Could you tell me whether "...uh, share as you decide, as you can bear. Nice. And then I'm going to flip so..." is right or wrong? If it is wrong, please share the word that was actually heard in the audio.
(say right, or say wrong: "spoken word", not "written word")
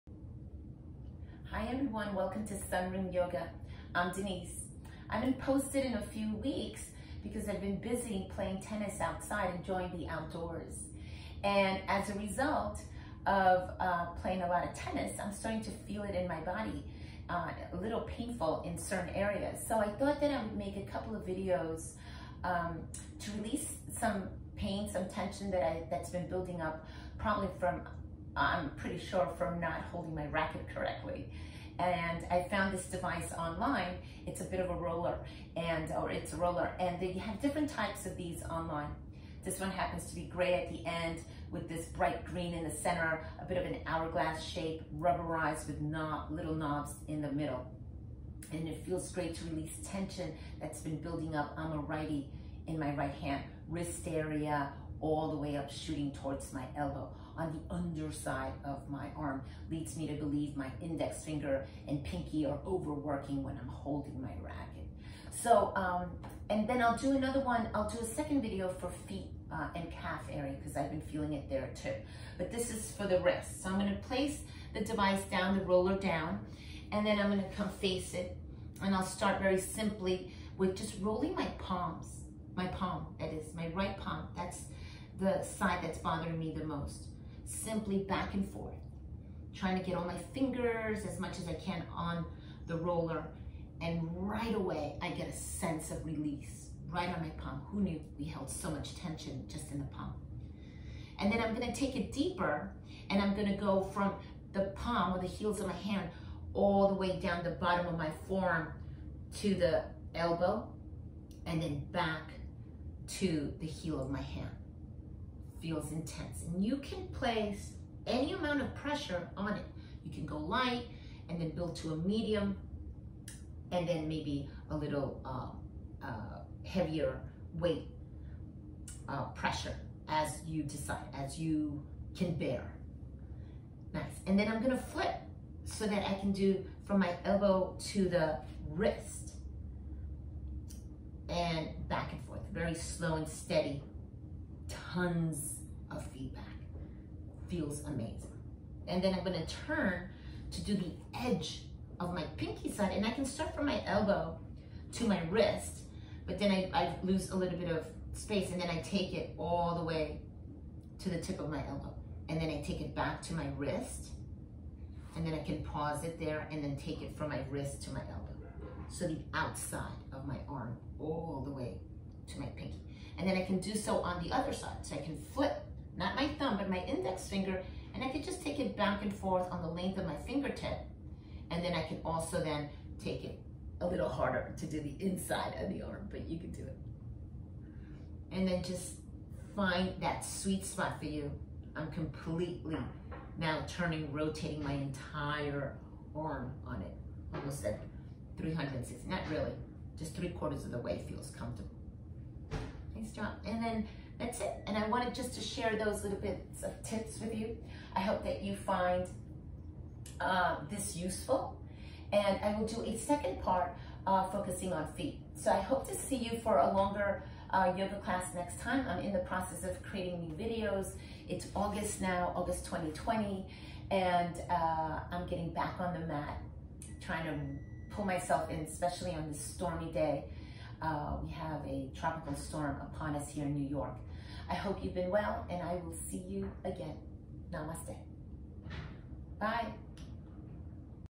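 wrong: "pressure", not "share".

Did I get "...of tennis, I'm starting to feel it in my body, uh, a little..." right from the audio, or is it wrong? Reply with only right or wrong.
right.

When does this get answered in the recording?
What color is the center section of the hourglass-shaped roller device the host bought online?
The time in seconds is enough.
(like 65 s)
41 s.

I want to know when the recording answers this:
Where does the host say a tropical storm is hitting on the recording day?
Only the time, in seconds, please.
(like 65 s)
233 s.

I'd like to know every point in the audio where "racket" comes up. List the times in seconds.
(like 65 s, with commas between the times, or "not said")
30 s, 64 s.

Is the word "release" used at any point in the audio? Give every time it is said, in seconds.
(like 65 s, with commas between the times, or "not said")
23 s, 49 s, 96 s.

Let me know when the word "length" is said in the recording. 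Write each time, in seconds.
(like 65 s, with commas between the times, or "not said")
179 s.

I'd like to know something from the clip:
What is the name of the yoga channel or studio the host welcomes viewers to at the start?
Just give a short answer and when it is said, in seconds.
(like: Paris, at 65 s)
Sunroom Yoga, at 2 s.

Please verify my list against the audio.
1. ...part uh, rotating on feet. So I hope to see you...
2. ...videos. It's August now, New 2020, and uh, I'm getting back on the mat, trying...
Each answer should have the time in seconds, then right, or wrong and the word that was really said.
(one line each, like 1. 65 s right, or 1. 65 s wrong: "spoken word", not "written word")
1. 213 s wrong: "focusing", not "rotating"
2. 220 s wrong: "August", not "New".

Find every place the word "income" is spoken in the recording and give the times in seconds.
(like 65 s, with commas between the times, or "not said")
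not said.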